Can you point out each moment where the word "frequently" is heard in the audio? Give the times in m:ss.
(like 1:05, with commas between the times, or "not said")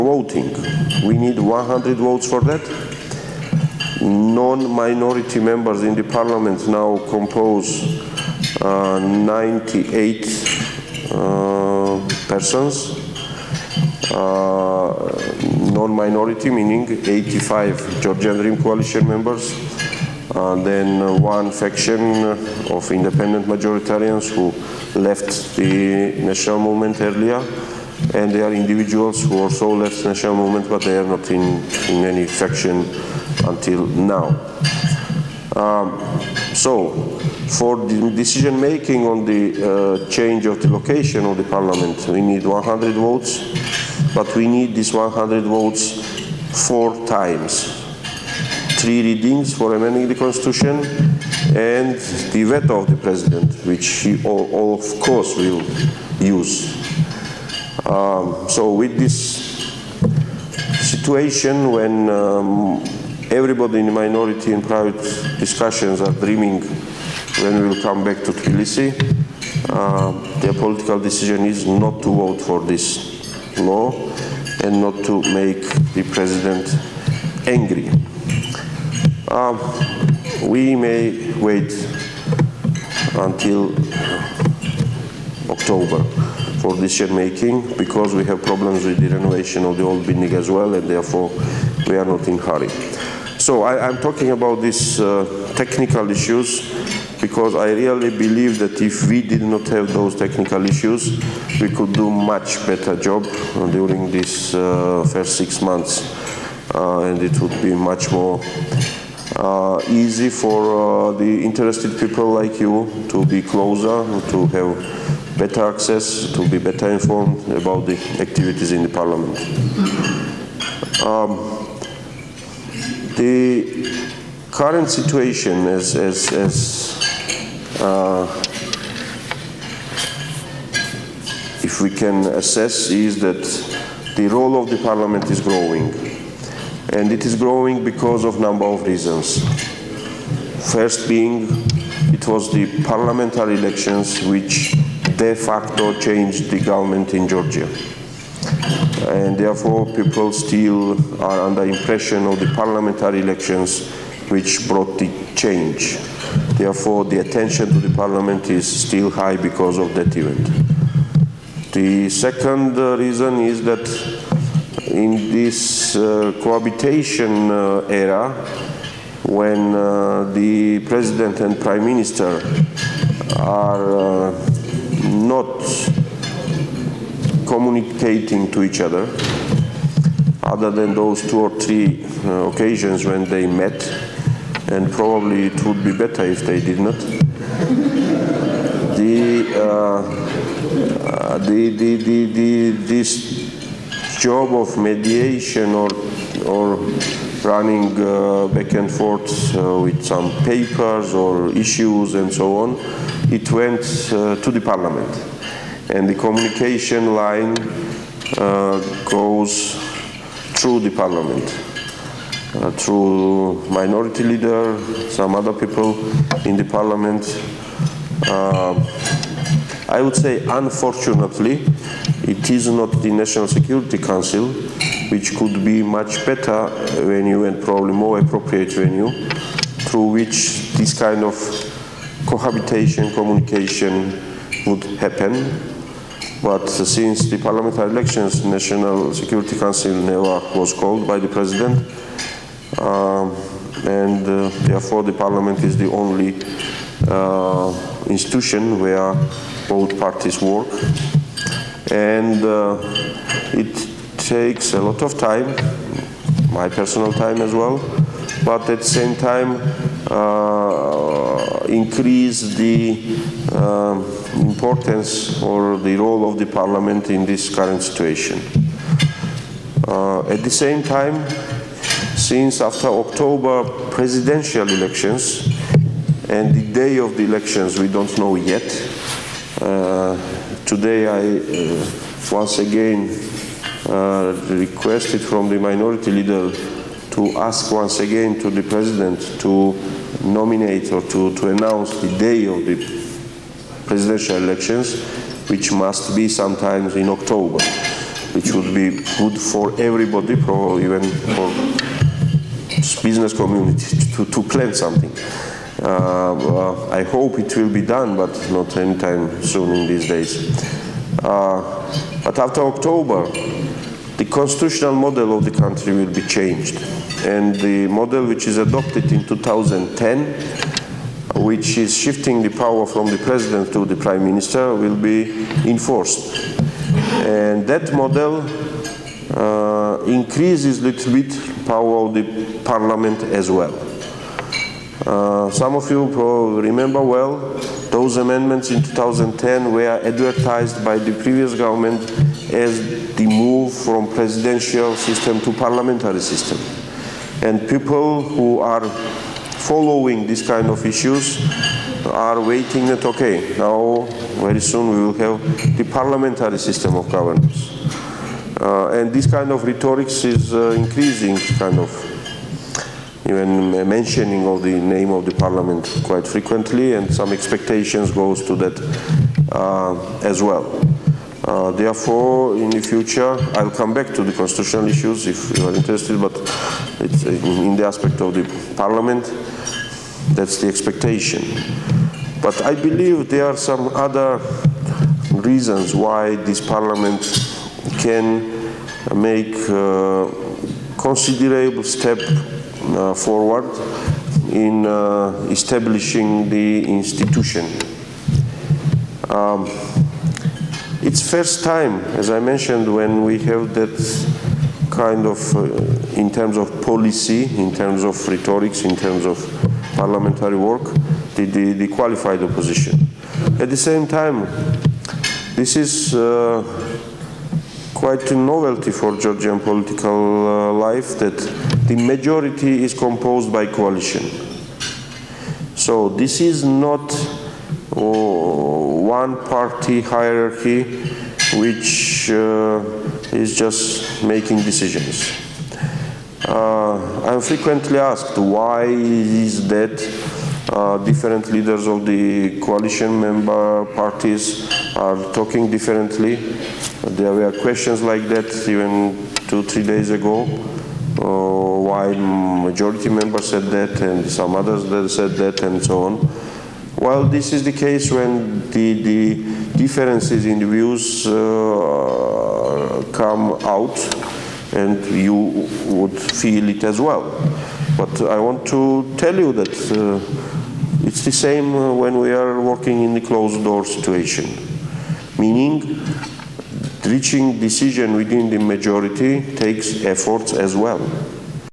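6:06, 7:17.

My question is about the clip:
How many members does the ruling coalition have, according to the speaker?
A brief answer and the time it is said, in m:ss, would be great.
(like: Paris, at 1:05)
85, at 0:16.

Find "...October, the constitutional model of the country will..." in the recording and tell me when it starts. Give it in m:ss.
5:12.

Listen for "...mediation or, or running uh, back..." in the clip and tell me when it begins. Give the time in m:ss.
3:14.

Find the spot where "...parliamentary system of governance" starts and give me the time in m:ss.
5:55.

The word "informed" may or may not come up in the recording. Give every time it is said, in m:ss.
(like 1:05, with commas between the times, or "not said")
1:56.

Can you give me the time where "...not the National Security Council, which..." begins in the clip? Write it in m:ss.
3:42.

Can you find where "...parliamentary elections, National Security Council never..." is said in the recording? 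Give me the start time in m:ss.
3:57.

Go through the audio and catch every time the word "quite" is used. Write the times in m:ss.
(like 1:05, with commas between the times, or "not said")
6:06, 6:57.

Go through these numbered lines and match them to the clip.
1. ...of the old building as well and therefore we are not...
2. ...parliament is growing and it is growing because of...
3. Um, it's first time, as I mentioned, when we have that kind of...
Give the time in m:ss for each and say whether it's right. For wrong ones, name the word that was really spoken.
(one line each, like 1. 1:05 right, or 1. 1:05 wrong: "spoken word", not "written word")
1. 1:29 right
2. 2:14 right
3. 6:39 right.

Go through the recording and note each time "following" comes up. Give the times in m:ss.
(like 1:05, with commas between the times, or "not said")
5:49.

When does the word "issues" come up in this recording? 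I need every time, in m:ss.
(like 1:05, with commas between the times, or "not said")
1:36, 1:40, 3:21, 5:50, 6:14.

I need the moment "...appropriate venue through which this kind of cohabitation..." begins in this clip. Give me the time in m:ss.
3:48.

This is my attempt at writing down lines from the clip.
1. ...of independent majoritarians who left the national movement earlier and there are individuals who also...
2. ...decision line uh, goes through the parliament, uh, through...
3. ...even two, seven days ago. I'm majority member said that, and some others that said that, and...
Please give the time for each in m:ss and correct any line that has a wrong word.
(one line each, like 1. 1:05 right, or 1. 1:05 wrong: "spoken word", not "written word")
1. 0:22 right
2. 3:26 wrong: "communication", not "decision"
3. 7:28 wrong: "three", not "seven".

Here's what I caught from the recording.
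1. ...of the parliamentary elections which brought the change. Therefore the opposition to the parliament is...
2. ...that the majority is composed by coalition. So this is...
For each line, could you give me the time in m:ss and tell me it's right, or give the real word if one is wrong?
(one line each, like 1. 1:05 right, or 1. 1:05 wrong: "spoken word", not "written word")
1. 2:32 wrong: "attention", not "opposition"
2. 7:01 right.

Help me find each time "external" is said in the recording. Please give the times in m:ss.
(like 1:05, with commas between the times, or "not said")
not said.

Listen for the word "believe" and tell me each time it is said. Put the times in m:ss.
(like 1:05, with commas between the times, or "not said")
1:38, 6:22.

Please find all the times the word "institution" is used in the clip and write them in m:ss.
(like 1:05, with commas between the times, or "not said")
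4:08, 6:36.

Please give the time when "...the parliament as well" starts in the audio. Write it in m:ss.
5:32.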